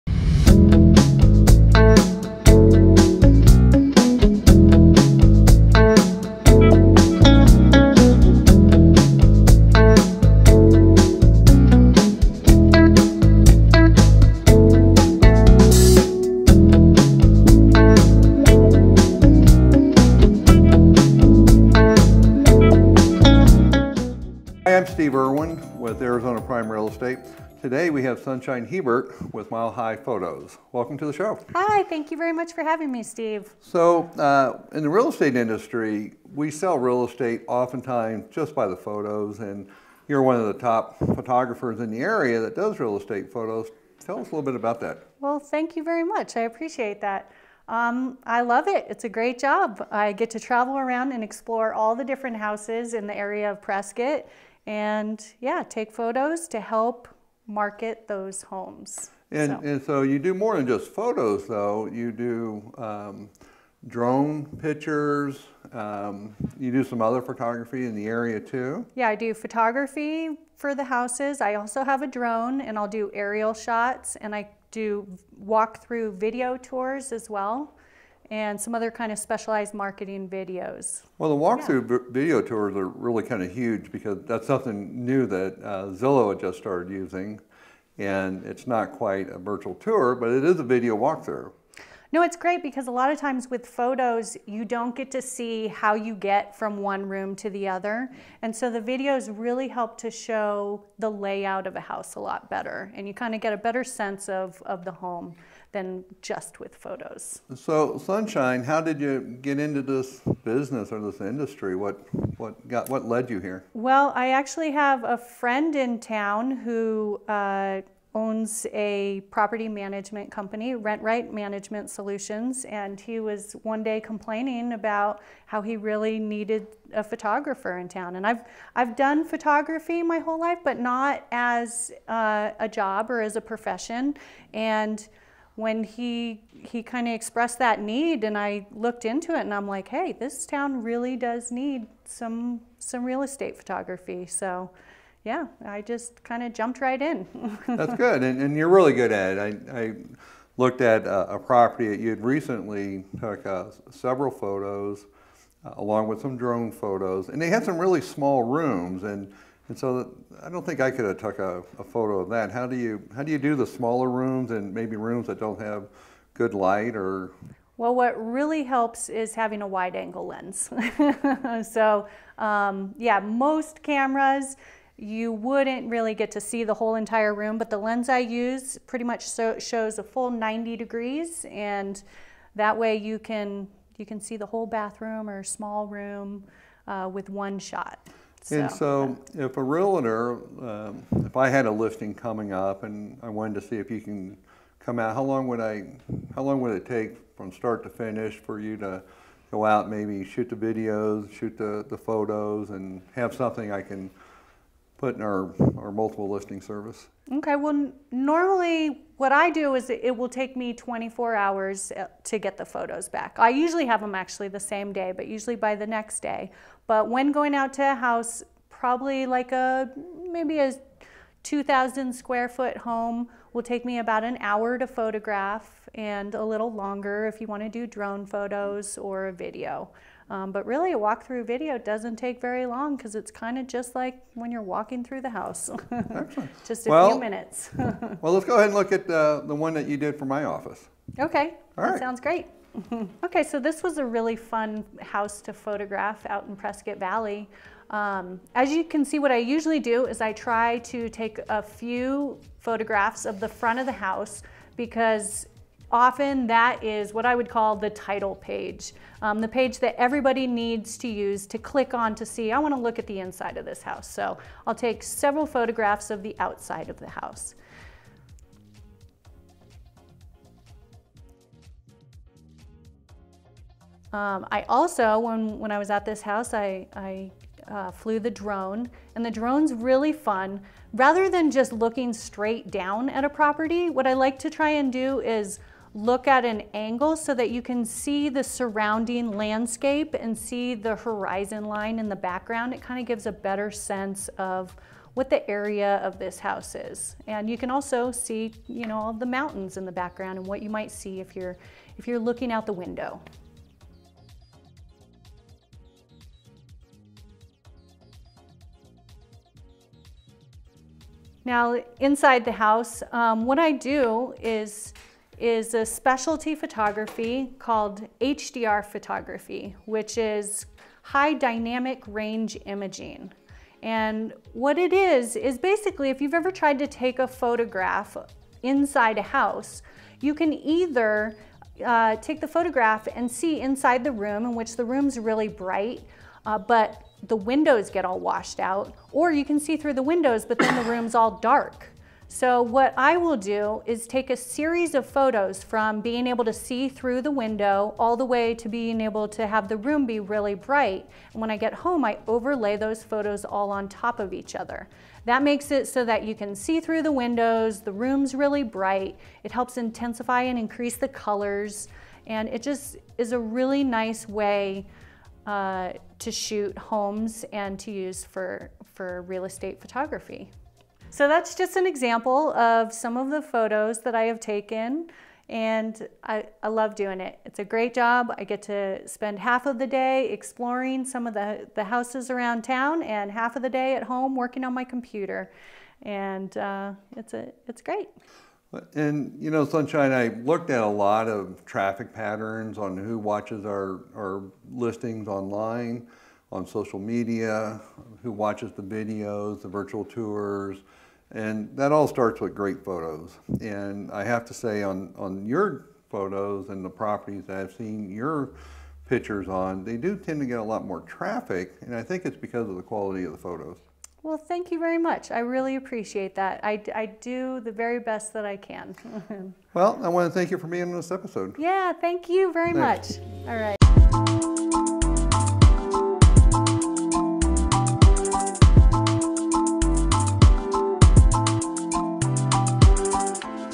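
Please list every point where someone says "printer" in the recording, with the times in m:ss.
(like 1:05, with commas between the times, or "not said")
not said.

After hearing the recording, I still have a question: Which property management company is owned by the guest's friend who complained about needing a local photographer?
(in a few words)
Rent Right Management Solutions.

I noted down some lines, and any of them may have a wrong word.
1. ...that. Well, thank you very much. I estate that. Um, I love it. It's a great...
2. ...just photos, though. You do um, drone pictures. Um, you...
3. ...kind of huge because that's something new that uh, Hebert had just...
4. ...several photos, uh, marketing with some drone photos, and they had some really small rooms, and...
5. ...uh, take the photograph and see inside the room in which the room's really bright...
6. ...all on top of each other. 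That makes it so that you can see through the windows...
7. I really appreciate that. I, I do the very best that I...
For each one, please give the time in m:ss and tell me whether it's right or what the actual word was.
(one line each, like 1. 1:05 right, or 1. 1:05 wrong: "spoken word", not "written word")
1. 0:44 wrong: "appreciate", not "estate"
2. 1:00 right
3. 1:23 wrong: "Zillow", not "Hebert"
4. 2:33 wrong: "along", not "marketing"
5. 5:31 right
6. 5:53 right
7. 6:55 right.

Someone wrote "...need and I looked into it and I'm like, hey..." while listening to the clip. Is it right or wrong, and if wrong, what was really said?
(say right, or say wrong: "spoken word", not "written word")
right.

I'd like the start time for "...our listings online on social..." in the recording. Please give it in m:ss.
6:34.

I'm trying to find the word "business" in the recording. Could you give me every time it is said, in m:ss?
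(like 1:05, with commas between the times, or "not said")
1:50.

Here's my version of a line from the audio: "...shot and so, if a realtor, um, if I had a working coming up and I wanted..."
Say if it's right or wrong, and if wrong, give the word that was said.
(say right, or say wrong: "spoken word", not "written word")
wrong: "listing", not "working".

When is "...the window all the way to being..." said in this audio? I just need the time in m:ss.
5:47.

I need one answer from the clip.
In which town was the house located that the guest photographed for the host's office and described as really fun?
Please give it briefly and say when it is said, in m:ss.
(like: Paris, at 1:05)
Prescott Valley, at 4:06.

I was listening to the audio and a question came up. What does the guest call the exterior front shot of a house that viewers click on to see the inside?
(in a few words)
the title page.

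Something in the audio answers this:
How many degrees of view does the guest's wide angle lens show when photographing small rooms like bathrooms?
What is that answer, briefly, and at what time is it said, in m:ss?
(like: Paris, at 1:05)
90 degrees, at 3:00.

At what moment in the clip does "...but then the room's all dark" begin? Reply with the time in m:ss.
5:40.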